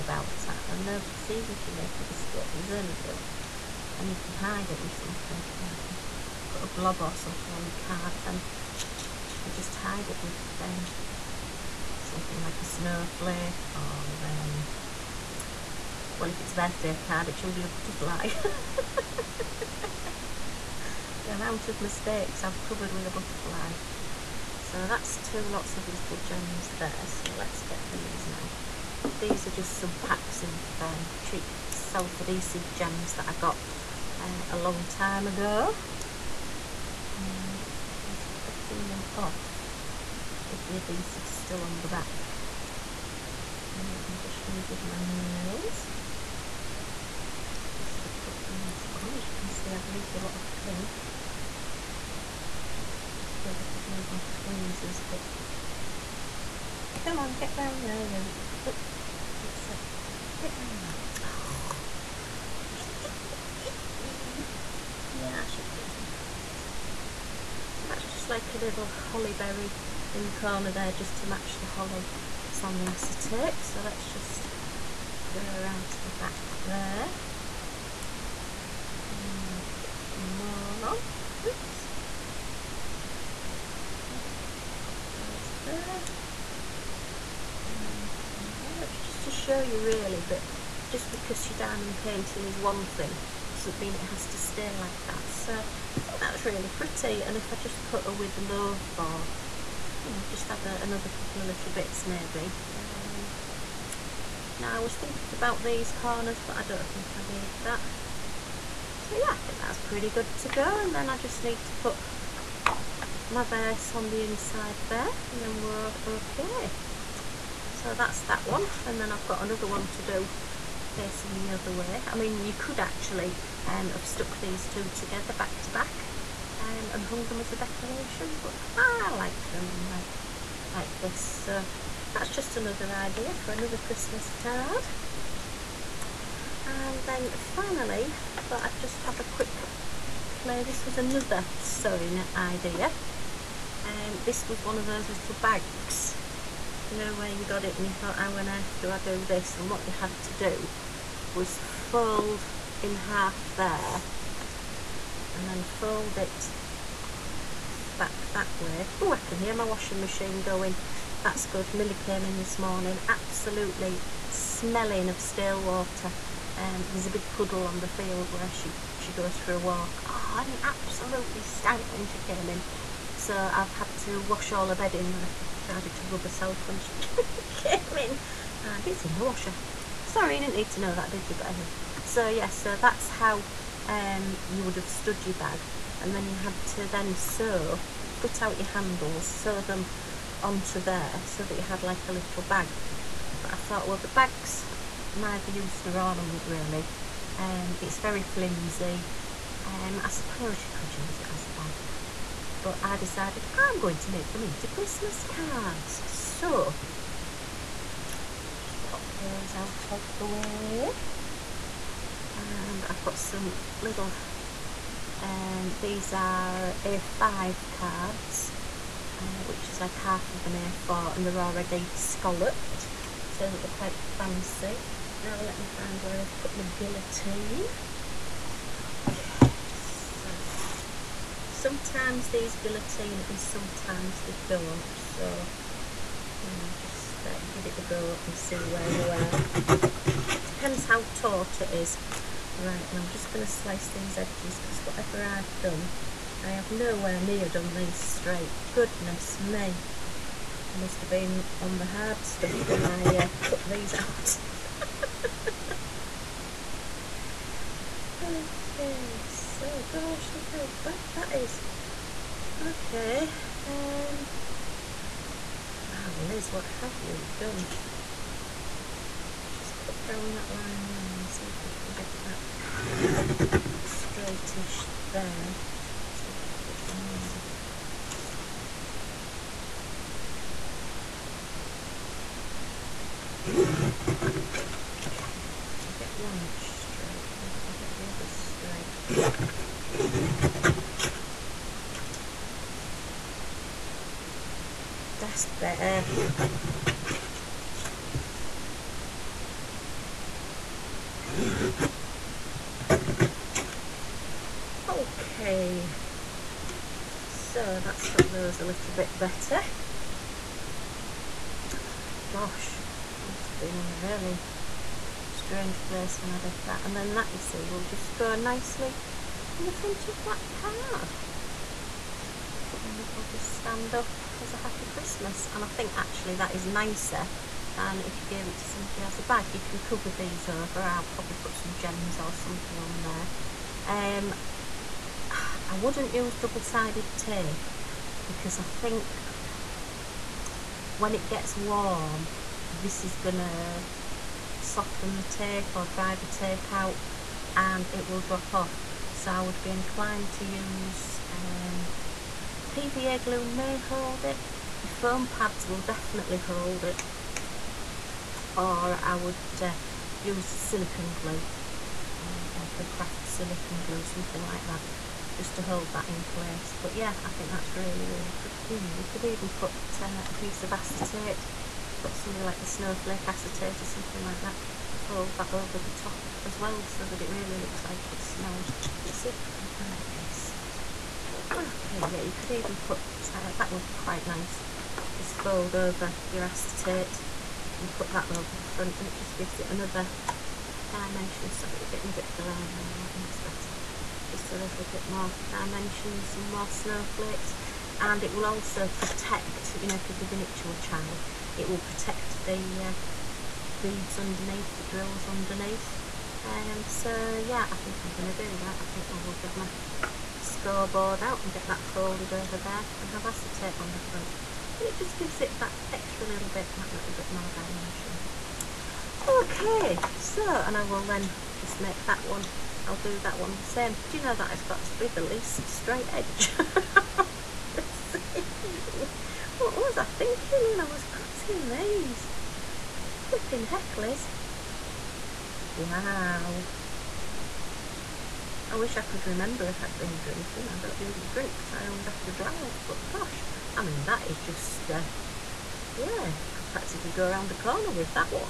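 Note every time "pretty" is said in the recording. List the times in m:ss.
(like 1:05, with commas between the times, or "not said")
1:36, 1:49, 6:08.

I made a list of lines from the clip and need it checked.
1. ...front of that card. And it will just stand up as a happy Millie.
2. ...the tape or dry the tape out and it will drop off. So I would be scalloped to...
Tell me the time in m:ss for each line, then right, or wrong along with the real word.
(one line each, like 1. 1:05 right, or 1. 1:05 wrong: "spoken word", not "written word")
1. 5:19 wrong: "Christmas", not "Millie"
2. 5:45 wrong: "inclined", not "scalloped".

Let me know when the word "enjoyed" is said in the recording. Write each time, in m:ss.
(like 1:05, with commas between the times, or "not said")
not said.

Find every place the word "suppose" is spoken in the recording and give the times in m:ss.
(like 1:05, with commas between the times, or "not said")
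0:53, 3:20.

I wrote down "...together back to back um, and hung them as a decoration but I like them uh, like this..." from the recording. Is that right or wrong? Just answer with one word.
right.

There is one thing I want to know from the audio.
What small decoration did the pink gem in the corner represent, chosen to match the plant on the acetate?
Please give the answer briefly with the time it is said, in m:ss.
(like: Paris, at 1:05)
holly berry, at 1:08.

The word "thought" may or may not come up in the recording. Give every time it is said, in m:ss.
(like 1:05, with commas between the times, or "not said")
2:18, 2:27, 3:13.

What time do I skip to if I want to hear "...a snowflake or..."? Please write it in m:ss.
0:12.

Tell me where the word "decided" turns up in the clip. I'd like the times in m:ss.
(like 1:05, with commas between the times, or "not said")
2:55, 3:22.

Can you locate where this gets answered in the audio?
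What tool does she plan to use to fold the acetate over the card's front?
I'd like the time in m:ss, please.
6:50.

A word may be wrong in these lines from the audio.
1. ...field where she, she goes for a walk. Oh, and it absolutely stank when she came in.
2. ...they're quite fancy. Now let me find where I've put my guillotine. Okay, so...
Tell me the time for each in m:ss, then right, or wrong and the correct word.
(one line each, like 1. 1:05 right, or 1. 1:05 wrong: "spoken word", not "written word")
1. 2:47 right
2. 3:43 right.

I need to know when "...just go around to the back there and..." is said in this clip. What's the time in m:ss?
1:14.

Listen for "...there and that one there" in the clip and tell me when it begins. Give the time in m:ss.
1:25.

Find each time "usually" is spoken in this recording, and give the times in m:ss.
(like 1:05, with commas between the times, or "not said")
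0:17, 7:20.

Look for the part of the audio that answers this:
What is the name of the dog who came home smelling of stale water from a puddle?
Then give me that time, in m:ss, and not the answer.
2:41.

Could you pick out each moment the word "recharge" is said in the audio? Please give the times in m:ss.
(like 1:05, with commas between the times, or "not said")
not said.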